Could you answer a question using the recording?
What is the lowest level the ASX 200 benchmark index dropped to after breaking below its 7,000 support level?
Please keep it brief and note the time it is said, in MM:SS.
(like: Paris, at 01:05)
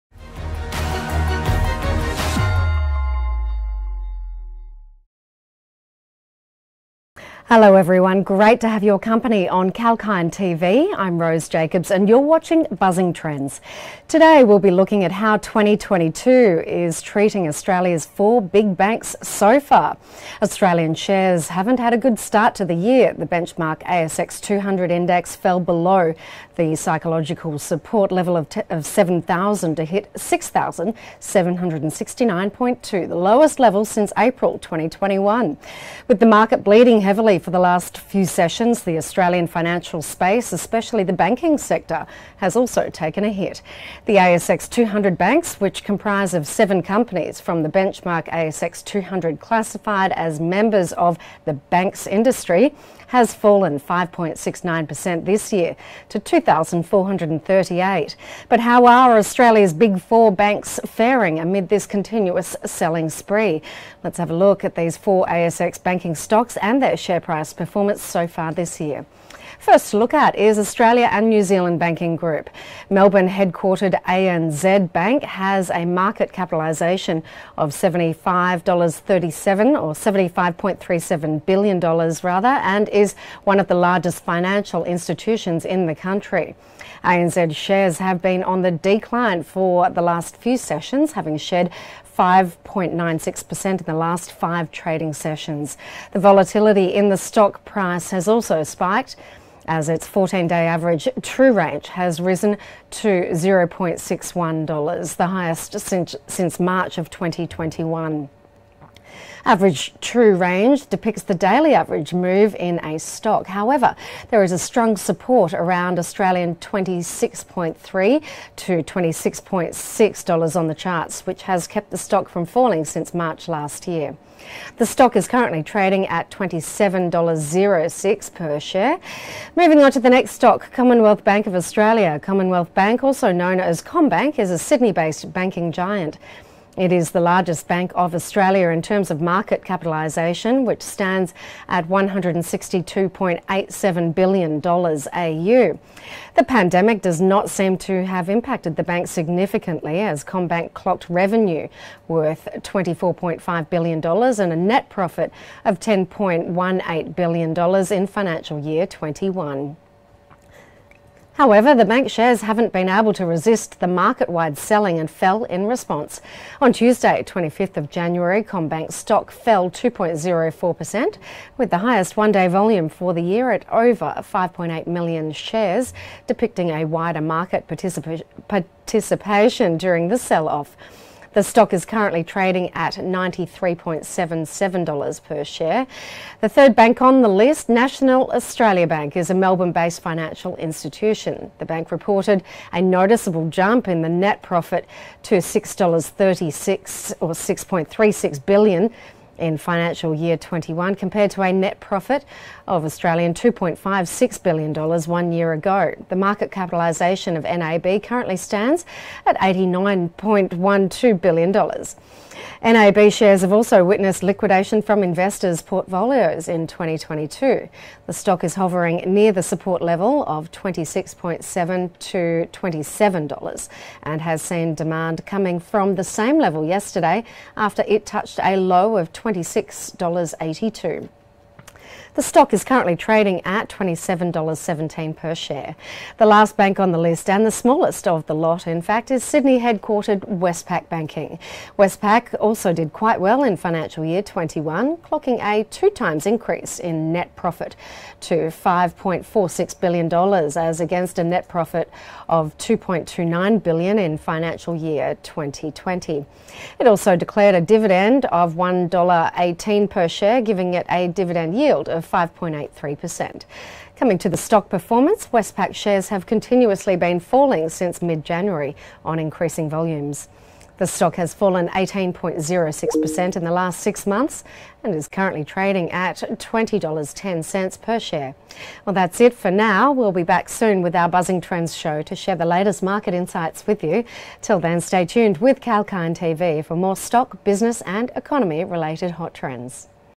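6,769.2, at 00:30.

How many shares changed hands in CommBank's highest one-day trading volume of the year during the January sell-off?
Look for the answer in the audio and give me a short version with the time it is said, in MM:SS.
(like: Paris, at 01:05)
over 5.8 million, at 02:53.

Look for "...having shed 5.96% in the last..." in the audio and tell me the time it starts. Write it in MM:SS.
01:31.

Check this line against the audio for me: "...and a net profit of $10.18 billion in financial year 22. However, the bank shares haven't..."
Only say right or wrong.
wrong.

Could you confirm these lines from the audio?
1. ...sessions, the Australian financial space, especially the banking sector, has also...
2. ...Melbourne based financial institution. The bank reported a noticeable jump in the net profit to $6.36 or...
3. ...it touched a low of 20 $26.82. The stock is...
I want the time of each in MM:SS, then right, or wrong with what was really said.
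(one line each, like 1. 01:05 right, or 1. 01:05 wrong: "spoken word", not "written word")
1. 00:38 right
2. 03:09 right
3. 03:47 right.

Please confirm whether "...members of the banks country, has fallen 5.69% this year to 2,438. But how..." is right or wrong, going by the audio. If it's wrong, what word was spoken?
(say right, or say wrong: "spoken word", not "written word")
wrong: "industry", not "country".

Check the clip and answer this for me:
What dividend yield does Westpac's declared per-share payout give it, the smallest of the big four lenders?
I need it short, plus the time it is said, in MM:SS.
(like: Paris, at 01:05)
5.83%, at 04:22.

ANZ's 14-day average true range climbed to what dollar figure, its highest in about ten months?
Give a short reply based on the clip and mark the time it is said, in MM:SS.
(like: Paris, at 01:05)
$0.61, at 01:43.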